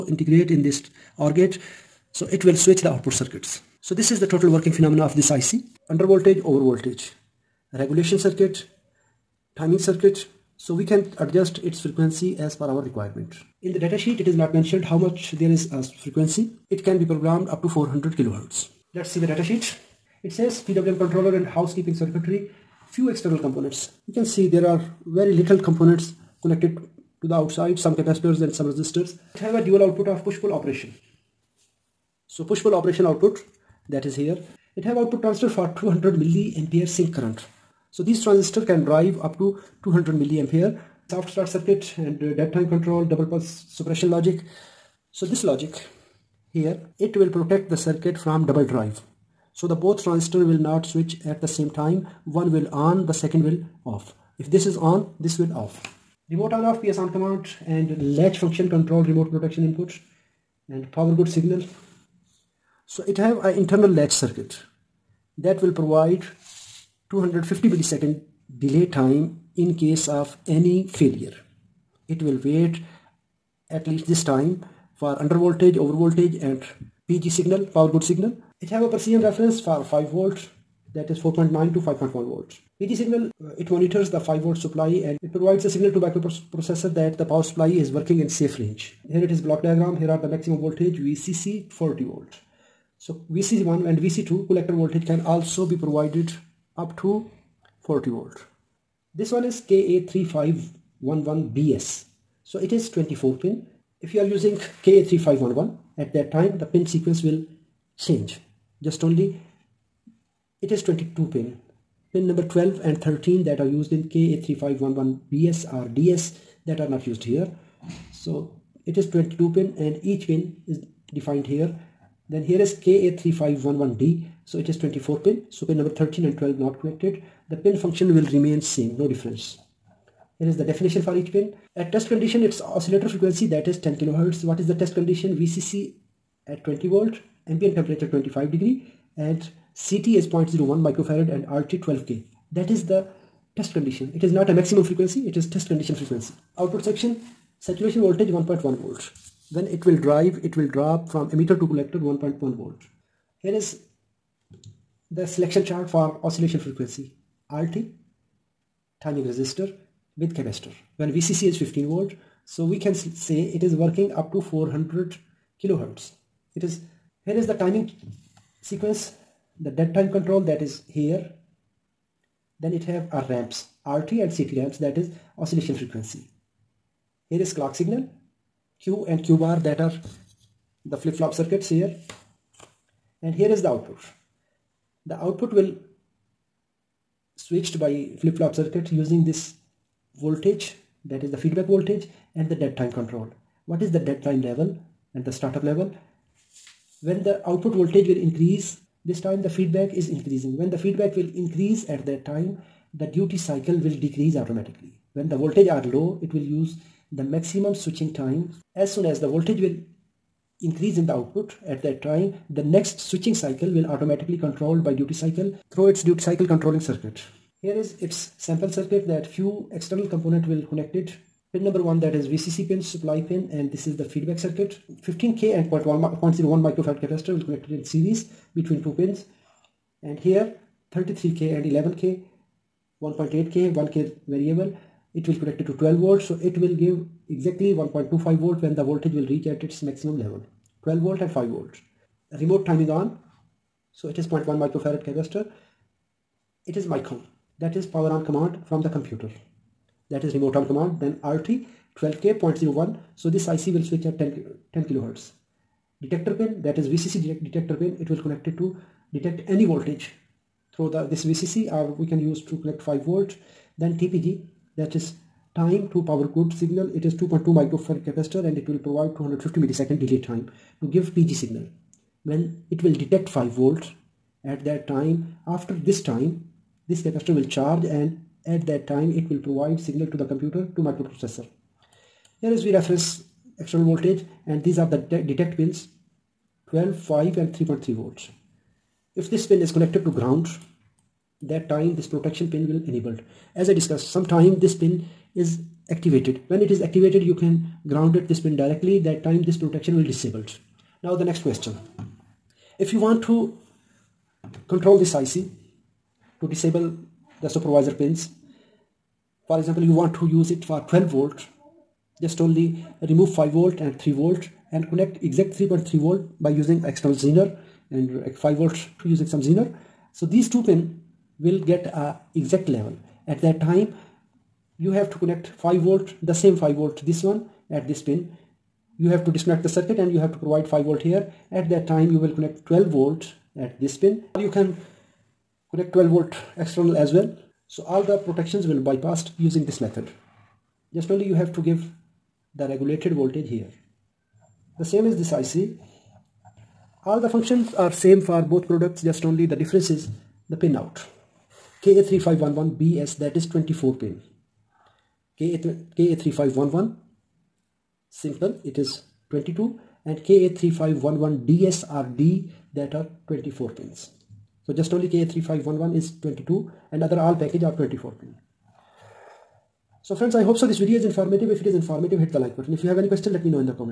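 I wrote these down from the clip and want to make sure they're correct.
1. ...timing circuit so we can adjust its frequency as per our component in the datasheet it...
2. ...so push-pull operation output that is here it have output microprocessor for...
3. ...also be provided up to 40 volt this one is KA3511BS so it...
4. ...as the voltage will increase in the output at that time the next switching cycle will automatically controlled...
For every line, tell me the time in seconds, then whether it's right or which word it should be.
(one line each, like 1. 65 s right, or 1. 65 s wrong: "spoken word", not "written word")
1. 9 s wrong: "requirement", not "component"
2. 32 s wrong: "transistor", not "microprocessor"
3. 95 s right
4. 209 s right.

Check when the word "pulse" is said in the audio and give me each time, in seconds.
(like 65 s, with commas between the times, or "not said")
43 s.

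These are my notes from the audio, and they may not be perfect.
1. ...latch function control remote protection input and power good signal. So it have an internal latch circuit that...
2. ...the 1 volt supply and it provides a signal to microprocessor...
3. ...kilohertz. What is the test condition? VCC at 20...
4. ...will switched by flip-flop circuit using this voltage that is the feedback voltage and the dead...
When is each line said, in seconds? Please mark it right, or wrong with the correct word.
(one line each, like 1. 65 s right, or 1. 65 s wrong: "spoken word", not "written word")
1. 58 s right
2. 84 s wrong: "5", not "1"
3. 133 s right
4. 185 s right.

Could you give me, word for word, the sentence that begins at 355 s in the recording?
KA3511 simple it is 22 and KA3511DS are D that are 24 pins.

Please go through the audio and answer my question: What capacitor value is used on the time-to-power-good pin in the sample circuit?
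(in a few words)
2.2 microfarad.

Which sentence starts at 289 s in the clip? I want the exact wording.
If this pin is connected to ground, that time this protection pin will enabled.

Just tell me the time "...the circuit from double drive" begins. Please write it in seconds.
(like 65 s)
47 s.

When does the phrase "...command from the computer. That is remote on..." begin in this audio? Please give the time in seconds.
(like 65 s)
248 s.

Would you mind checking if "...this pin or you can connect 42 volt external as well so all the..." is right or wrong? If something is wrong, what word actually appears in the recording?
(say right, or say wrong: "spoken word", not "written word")
wrong: "12", not "42".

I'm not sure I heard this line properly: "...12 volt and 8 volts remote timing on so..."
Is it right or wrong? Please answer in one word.
wrong.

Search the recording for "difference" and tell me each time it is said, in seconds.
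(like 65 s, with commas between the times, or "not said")
129 s, 349 s.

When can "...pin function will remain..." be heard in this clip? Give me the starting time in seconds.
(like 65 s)
127 s.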